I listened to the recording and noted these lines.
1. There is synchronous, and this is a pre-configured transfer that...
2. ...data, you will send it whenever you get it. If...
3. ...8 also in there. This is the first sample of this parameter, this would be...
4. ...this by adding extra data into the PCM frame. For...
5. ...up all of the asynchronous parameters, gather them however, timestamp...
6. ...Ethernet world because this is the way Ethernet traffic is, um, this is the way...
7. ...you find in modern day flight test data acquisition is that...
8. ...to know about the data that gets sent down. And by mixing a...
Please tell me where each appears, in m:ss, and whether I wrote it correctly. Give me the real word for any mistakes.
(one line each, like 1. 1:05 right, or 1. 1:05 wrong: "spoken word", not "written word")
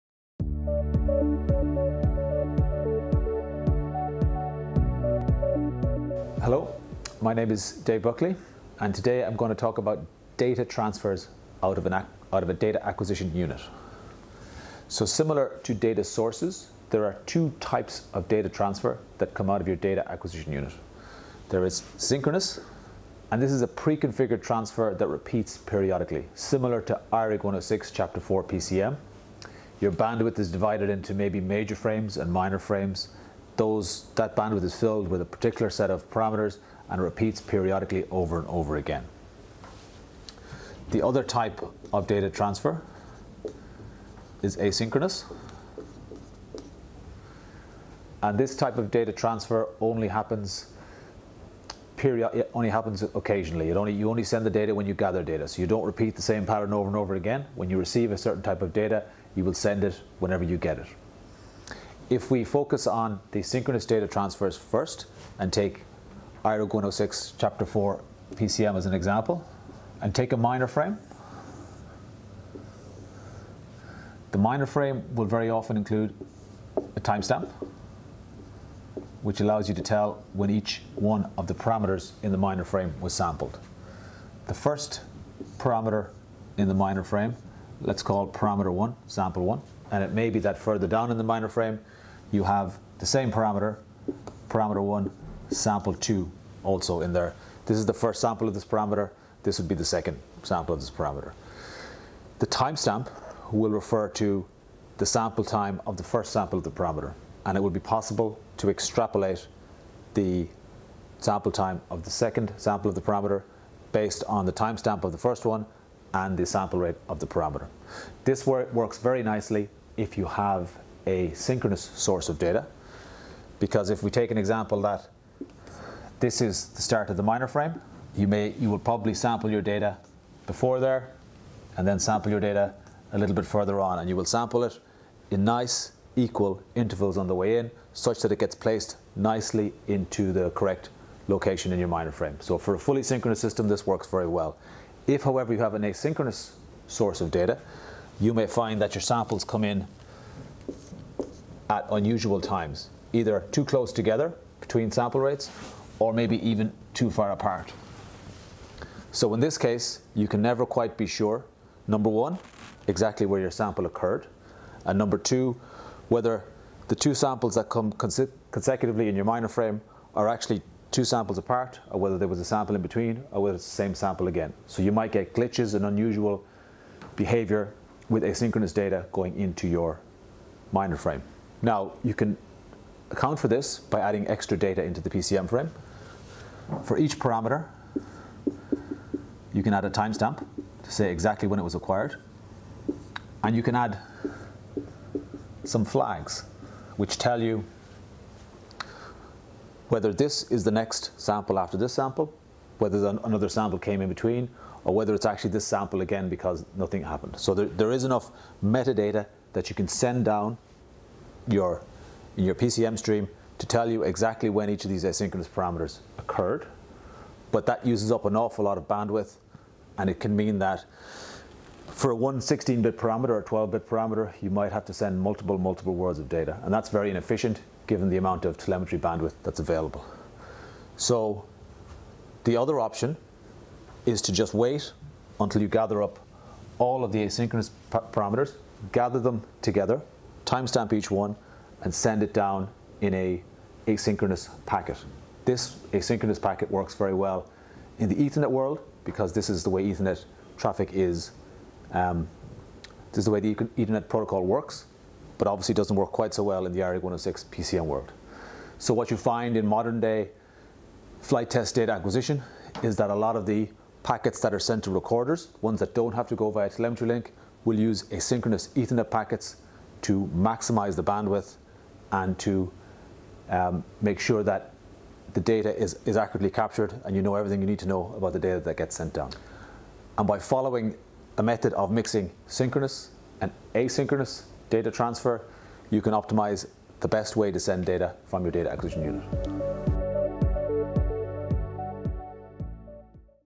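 1. 0:21 right
2. 0:58 right
3. 1:35 wrong: "2", not "8"
4. 3:03 right
5. 3:56 wrong: "together", not "however"
6. 4:08 right
7. 4:19 right
8. 4:37 wrong: "following", not "mixing".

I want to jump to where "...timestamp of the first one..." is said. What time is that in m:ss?
1:54.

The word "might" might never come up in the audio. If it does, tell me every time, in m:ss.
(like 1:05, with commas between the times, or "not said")
2:54, 3:44.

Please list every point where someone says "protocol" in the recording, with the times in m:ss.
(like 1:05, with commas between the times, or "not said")
4:14.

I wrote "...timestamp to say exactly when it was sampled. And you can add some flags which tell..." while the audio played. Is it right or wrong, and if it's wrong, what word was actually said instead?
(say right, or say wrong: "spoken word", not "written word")
wrong: "acquired", not "sampled".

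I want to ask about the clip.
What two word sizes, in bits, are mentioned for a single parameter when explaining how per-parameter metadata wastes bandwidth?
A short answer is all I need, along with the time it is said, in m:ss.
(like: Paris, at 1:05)
16-bit and 12-bit, at 3:42.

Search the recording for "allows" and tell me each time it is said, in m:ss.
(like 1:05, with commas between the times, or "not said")
1:19.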